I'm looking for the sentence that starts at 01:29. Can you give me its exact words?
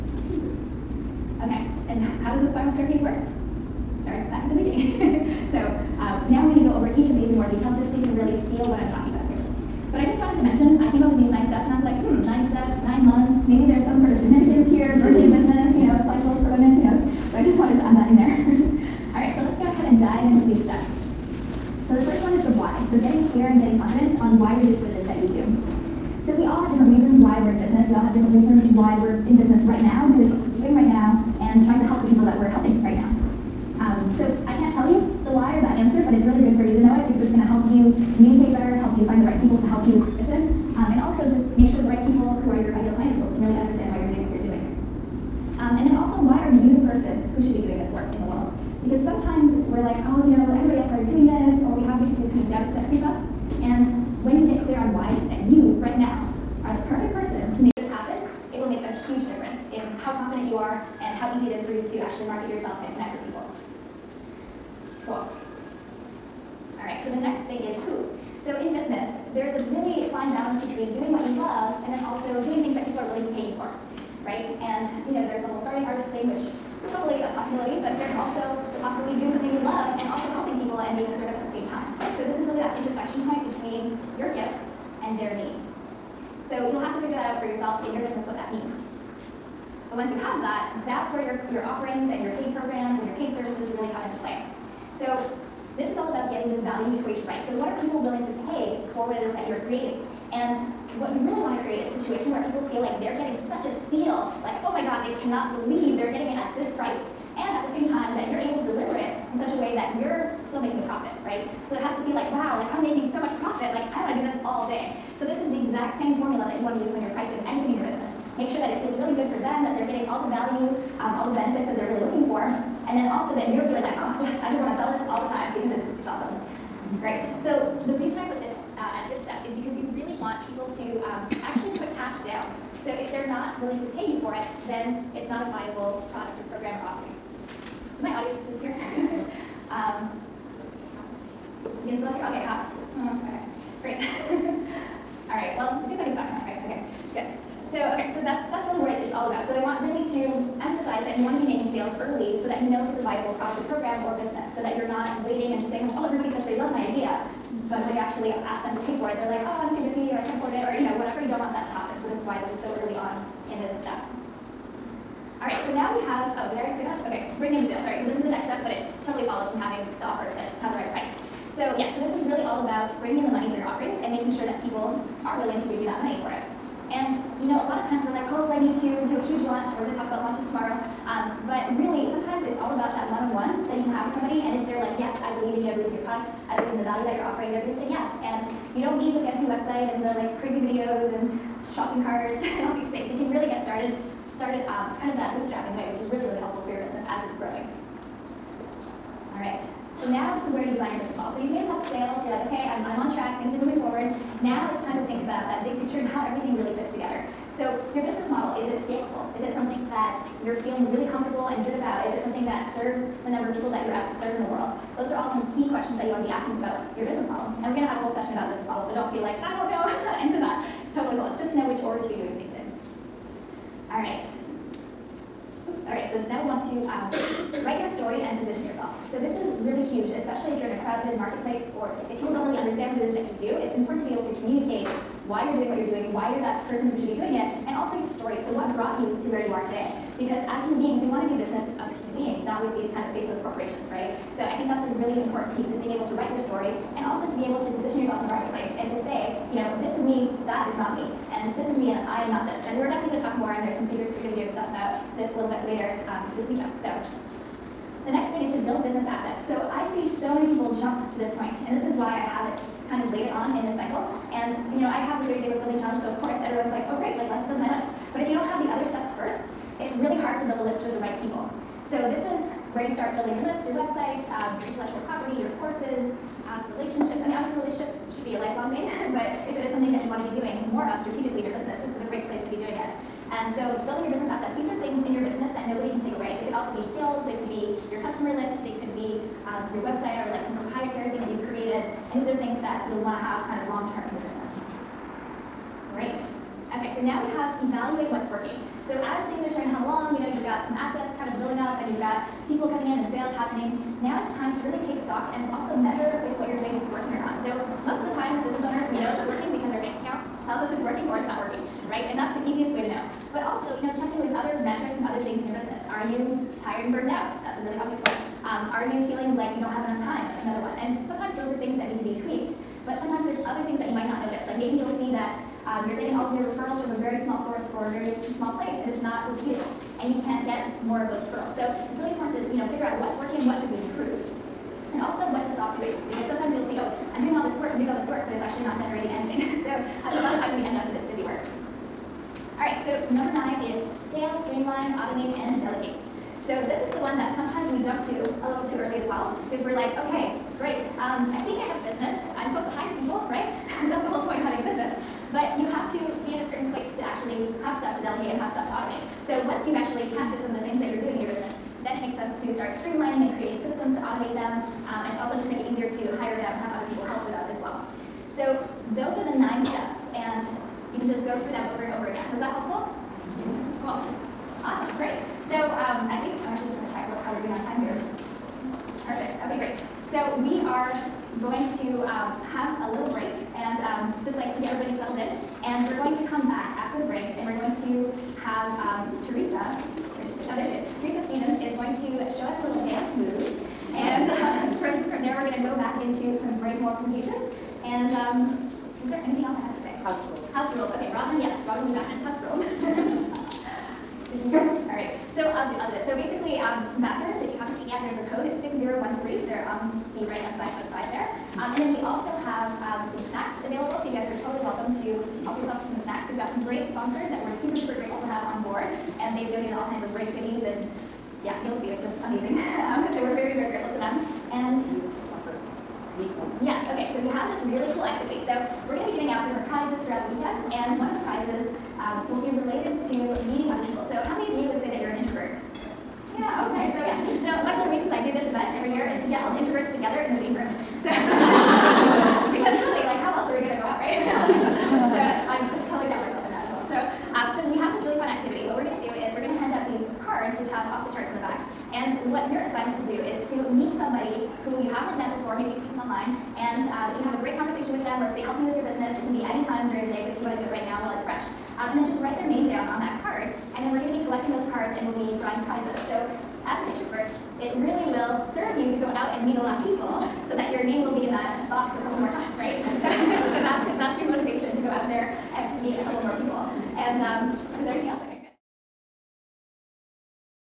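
And once you have that, that's where your, your offerings and your paid programs and your paid services really come into play.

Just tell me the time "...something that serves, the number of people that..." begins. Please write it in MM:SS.
03:29.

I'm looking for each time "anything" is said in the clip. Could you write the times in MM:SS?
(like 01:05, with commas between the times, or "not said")
01:57, 05:39, 06:39.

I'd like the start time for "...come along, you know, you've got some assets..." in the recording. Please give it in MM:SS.
04:59.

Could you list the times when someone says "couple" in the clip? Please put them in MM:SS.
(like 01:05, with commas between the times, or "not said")
03:21, 07:52, 07:56.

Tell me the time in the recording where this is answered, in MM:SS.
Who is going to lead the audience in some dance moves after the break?
06:31.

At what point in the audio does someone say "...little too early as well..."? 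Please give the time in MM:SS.
05:48.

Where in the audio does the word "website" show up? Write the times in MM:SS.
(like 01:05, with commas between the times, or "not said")
03:09, 04:33, 04:49.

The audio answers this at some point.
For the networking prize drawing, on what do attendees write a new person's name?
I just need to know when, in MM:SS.
07:43.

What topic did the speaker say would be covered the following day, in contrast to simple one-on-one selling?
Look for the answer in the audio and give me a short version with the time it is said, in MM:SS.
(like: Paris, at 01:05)
launches, at 03:00.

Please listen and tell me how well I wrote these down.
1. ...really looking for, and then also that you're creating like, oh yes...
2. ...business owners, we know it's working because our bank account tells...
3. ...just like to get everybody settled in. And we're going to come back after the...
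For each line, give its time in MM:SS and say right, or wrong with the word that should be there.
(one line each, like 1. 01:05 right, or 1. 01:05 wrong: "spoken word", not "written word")
1. 02:01 wrong: "feeling", not "creating"
2. 05:08 right
3. 06:24 right.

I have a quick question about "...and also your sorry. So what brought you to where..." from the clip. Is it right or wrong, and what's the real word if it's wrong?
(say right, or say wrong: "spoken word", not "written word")
wrong: "story", not "sorry".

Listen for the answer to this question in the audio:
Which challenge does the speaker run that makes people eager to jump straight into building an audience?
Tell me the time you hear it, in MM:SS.
04:25.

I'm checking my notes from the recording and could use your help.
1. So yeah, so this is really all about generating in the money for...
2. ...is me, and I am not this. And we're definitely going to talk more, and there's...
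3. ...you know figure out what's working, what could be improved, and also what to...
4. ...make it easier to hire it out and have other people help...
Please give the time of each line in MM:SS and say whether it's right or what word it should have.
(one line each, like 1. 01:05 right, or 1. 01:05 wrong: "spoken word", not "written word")
1. 02:51 wrong: "bringing", not "generating"
2. 04:11 right
3. 05:32 right
4. 06:05 right.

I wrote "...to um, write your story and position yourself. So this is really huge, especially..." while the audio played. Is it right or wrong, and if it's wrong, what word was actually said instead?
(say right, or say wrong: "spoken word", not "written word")
right.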